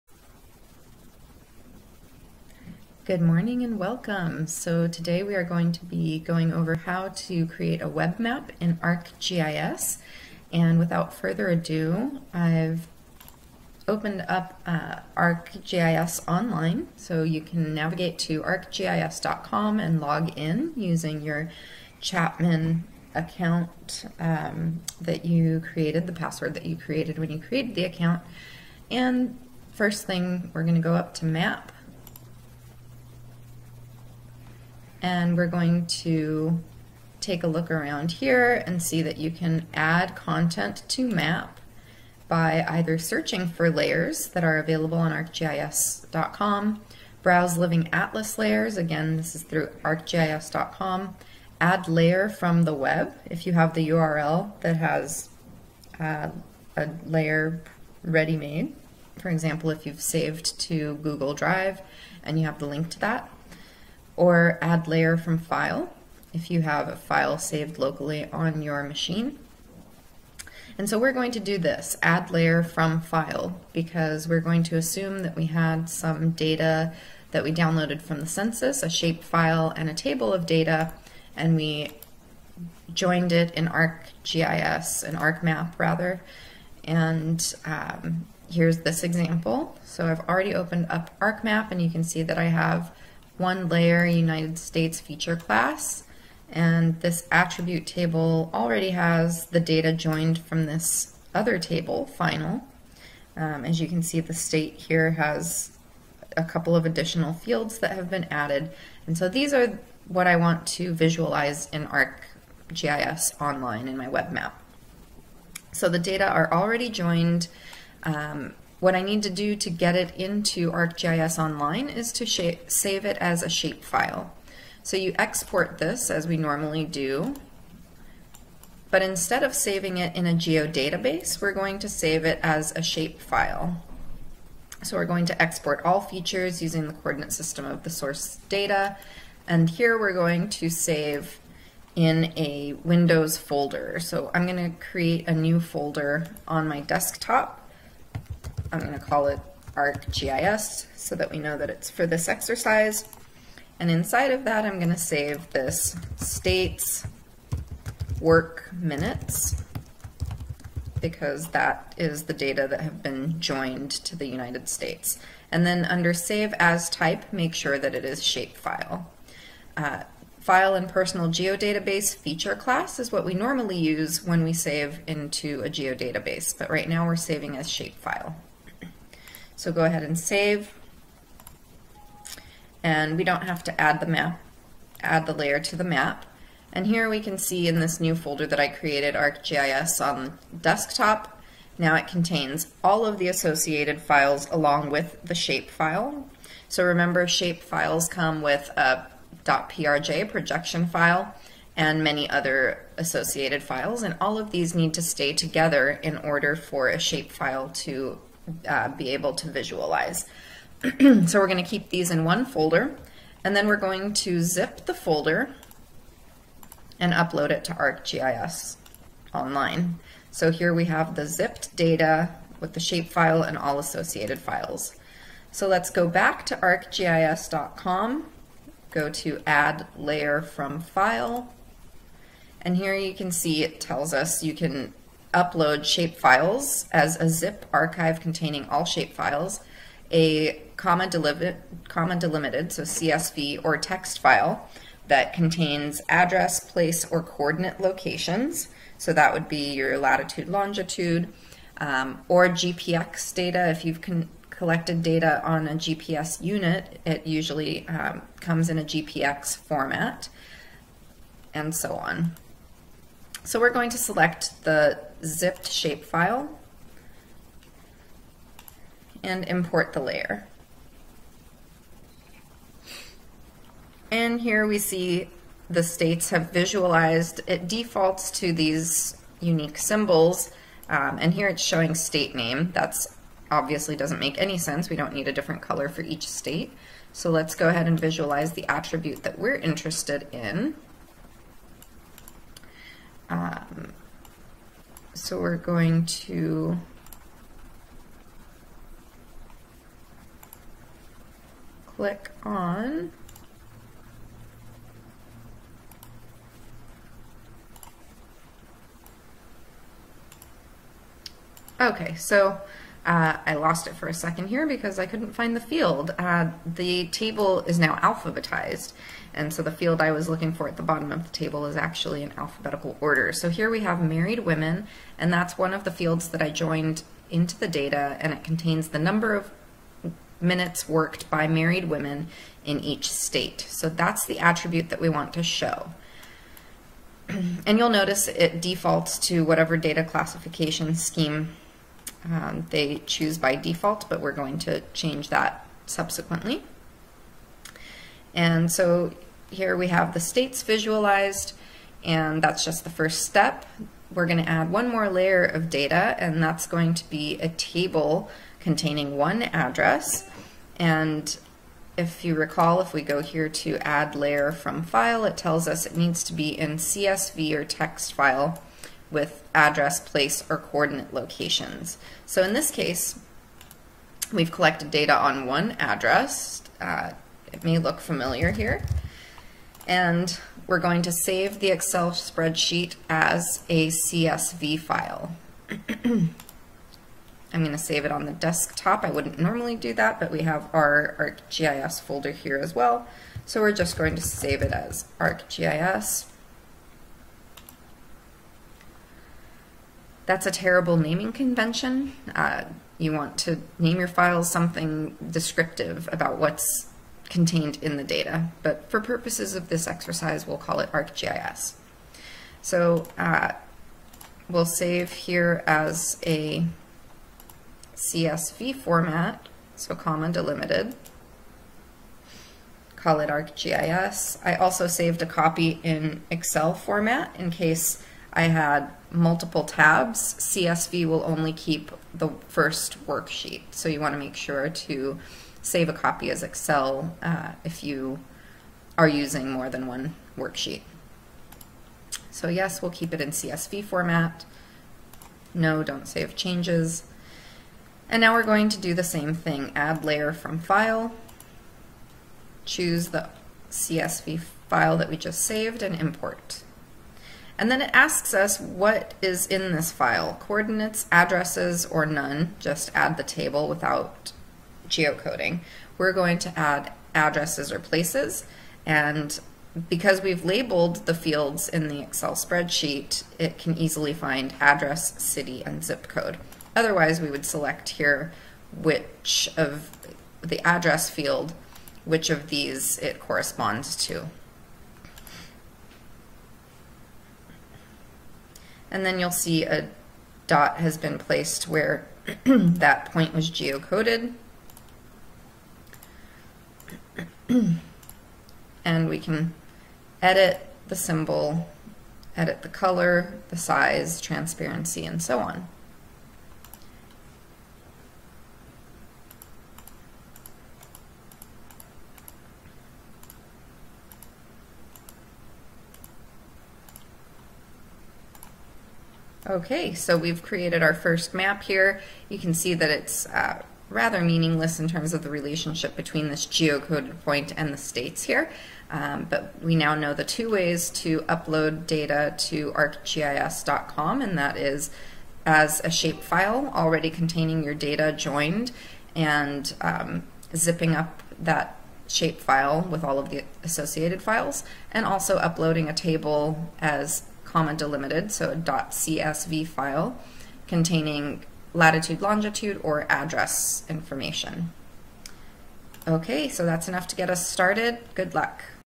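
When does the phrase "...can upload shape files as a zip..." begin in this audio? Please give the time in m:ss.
3:54.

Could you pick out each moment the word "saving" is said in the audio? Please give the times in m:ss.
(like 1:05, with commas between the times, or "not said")
2:09, 2:57.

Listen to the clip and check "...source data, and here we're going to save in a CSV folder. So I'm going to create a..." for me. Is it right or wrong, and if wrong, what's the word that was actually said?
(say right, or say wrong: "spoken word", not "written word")
wrong: "Windows", not "CSV".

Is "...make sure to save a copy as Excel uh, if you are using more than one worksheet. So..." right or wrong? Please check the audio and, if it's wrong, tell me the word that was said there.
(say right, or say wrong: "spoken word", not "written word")
right.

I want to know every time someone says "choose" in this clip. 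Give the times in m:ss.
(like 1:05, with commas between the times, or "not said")
5:43, 7:32.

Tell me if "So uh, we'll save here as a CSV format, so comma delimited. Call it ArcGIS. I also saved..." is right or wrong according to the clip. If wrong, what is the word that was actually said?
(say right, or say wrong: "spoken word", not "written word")
right.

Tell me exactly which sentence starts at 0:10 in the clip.
And without further ado, I've opened up uh, ArcGIS online.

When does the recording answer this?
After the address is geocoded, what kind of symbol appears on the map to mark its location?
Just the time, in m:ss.
8:09.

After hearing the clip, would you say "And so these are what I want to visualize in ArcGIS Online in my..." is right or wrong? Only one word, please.
right.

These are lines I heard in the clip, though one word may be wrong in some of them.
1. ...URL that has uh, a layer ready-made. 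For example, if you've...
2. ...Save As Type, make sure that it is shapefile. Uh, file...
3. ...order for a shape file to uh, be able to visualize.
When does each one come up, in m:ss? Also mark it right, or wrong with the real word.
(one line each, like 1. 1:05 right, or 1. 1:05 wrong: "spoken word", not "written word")
1. 0:53 right
2. 2:46 right
3. 3:26 right.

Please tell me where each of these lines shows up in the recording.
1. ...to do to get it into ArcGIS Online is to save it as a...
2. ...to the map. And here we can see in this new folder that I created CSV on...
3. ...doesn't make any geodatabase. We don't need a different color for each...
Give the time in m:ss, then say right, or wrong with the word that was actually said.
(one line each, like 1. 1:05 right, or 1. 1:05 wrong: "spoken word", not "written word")
1. 1:59 right
2. 3:05 wrong: "ArcGIS", not "CSV"
3. 4:43 wrong: "sense", not "geodatabase".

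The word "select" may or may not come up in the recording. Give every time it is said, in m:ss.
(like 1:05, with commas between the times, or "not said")
4:23, 7:57.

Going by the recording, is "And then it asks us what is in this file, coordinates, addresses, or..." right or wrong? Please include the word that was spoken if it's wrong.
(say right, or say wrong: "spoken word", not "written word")
right.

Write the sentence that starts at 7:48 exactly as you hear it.
And because we've labeled the fields in the Excel spreadsheet, it can easily find address, city, and zip code.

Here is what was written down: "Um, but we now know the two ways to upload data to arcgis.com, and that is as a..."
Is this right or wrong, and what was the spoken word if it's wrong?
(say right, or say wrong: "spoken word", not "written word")
right.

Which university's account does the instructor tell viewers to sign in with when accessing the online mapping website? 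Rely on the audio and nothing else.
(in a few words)
Chapman.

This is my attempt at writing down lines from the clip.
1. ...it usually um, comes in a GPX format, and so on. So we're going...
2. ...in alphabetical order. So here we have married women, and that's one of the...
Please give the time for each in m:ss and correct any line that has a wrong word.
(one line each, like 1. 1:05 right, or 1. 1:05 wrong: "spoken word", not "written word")
1. 4:17 right
2. 5:22 right.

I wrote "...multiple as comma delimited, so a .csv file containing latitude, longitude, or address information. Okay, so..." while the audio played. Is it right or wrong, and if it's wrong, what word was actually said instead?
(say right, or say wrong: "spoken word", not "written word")
wrong: "table", not "multiple".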